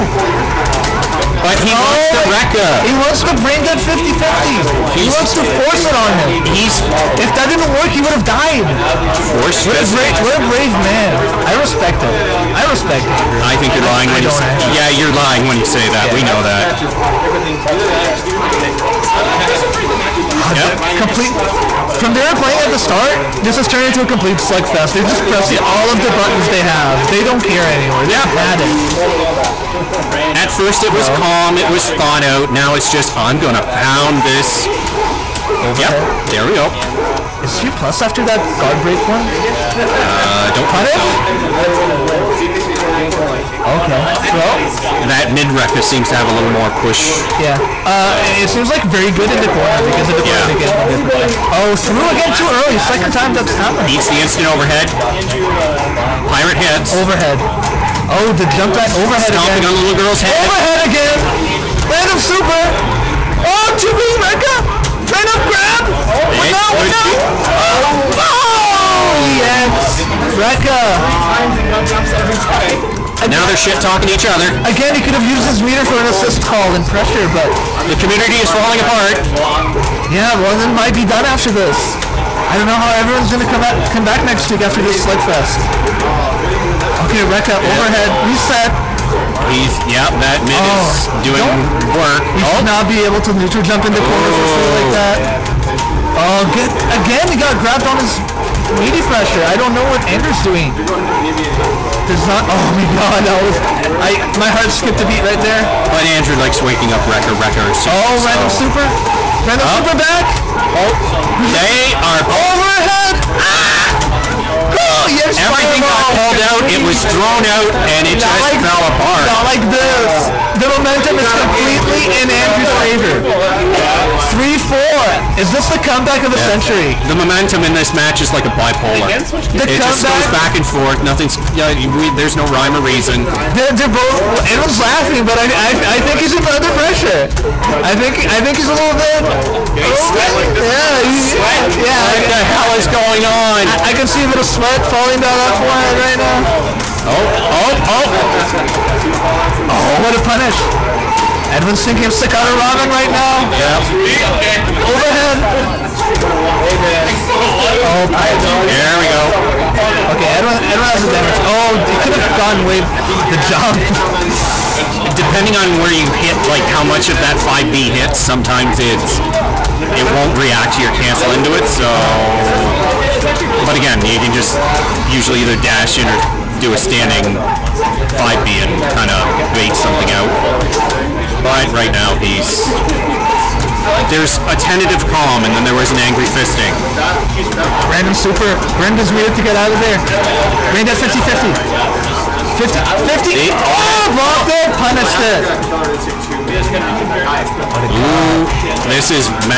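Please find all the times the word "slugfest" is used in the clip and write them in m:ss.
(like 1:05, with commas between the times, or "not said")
0:24, 1:25.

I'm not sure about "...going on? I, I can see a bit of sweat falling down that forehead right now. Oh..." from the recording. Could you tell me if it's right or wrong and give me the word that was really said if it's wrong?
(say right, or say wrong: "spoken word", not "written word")
right.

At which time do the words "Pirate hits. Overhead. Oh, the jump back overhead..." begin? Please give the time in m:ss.
0:56.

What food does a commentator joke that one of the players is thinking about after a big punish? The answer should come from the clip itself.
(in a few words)
Sakata Ramen.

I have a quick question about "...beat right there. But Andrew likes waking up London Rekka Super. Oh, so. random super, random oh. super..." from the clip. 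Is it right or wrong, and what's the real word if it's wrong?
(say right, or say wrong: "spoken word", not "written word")
wrong: "Rekka", not "London".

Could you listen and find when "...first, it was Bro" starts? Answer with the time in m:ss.
0:30.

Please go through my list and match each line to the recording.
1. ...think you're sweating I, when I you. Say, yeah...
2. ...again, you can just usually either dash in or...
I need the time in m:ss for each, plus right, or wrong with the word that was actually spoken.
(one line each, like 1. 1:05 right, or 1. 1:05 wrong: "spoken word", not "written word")
1. 0:13 wrong: "lying", not "sweating"
2. 2:53 right.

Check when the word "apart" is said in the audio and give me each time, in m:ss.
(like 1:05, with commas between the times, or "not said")
1:18, 1:58.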